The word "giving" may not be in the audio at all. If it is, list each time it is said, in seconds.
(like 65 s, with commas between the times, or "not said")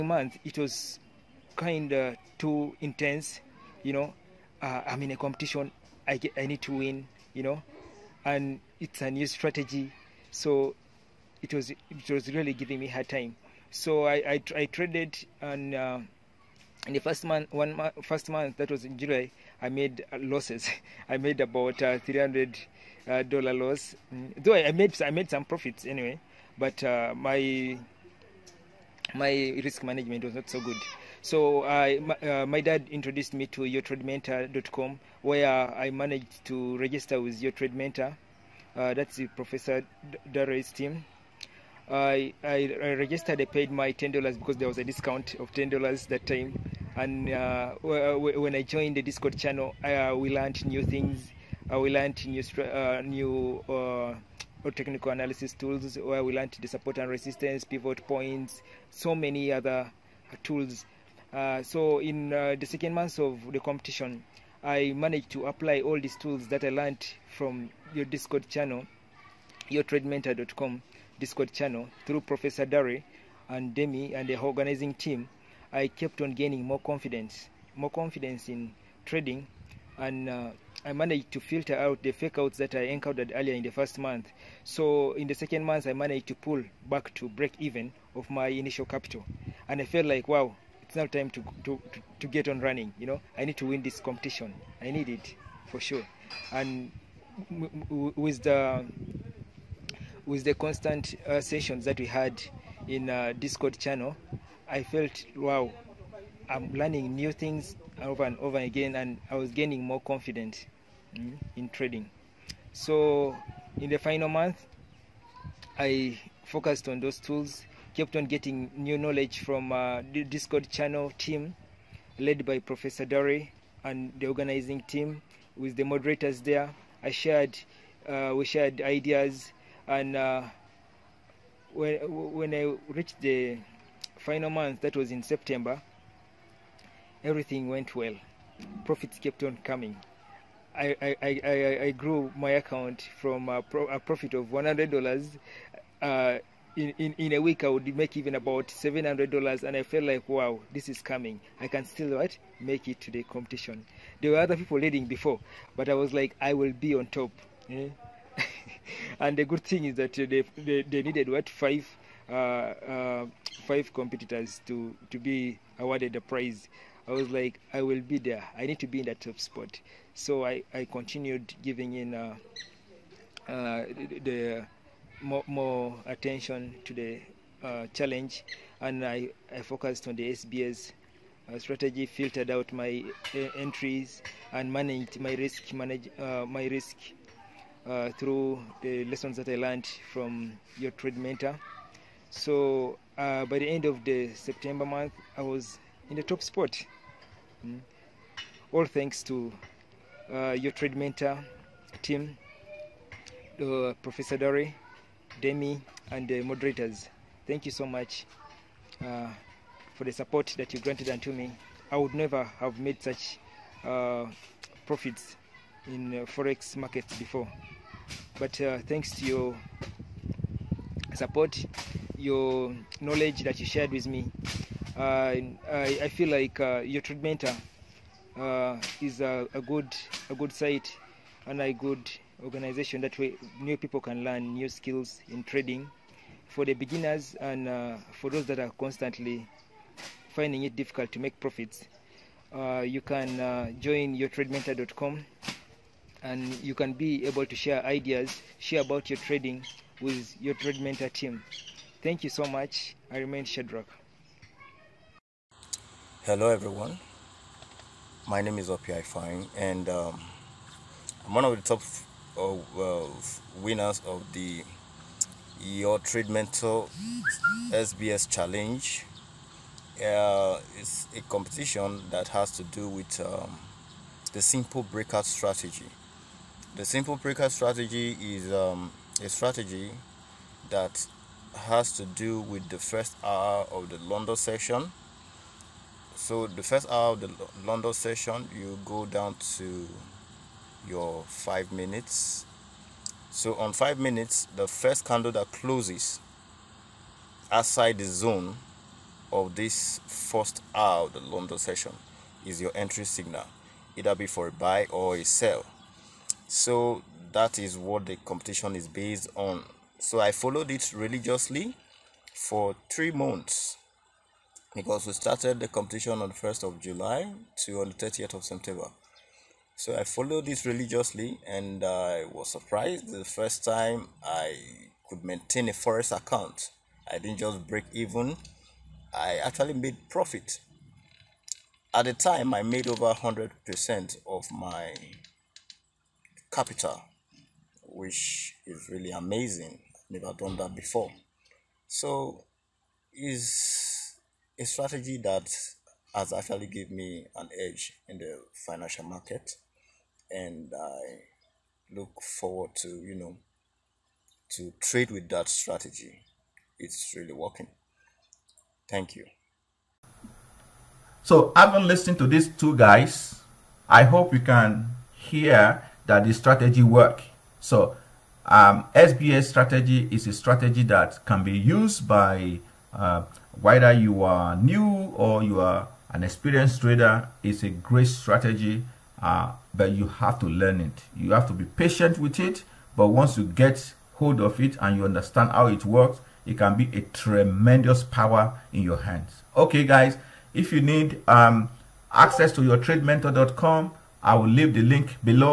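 12 s, 171 s.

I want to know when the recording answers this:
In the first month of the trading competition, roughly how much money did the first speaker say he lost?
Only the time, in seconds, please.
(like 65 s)
21 s.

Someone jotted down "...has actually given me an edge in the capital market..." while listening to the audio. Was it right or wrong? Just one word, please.
wrong.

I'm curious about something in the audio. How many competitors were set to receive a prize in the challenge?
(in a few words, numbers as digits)
5.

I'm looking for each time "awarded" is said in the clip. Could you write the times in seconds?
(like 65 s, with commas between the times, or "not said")
165 s.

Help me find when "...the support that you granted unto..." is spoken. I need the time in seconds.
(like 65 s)
210 s.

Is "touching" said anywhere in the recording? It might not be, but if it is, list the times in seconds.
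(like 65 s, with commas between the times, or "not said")
not said.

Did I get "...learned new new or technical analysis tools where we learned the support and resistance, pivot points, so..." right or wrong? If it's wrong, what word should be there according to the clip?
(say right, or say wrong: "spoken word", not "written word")
right.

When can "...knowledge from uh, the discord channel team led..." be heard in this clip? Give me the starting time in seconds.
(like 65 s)
118 s.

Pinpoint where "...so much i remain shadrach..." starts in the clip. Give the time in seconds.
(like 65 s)
252 s.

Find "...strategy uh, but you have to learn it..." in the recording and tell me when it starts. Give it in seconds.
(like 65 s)
378 s.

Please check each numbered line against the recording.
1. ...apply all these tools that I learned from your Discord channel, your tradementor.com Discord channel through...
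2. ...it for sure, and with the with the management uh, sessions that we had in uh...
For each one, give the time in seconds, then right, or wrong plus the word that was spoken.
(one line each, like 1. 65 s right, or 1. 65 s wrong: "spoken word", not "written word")
1. 65 s right
2. 95 s wrong: "constant", not "management".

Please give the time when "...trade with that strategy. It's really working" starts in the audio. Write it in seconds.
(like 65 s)
354 s.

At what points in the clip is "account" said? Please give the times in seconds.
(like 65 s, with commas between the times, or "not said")
142 s, 326 s.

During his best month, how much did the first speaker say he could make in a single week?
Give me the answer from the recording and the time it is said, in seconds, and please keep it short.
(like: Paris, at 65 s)
$700, at 148 s.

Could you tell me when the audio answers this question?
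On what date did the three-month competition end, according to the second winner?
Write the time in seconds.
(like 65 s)
317 s.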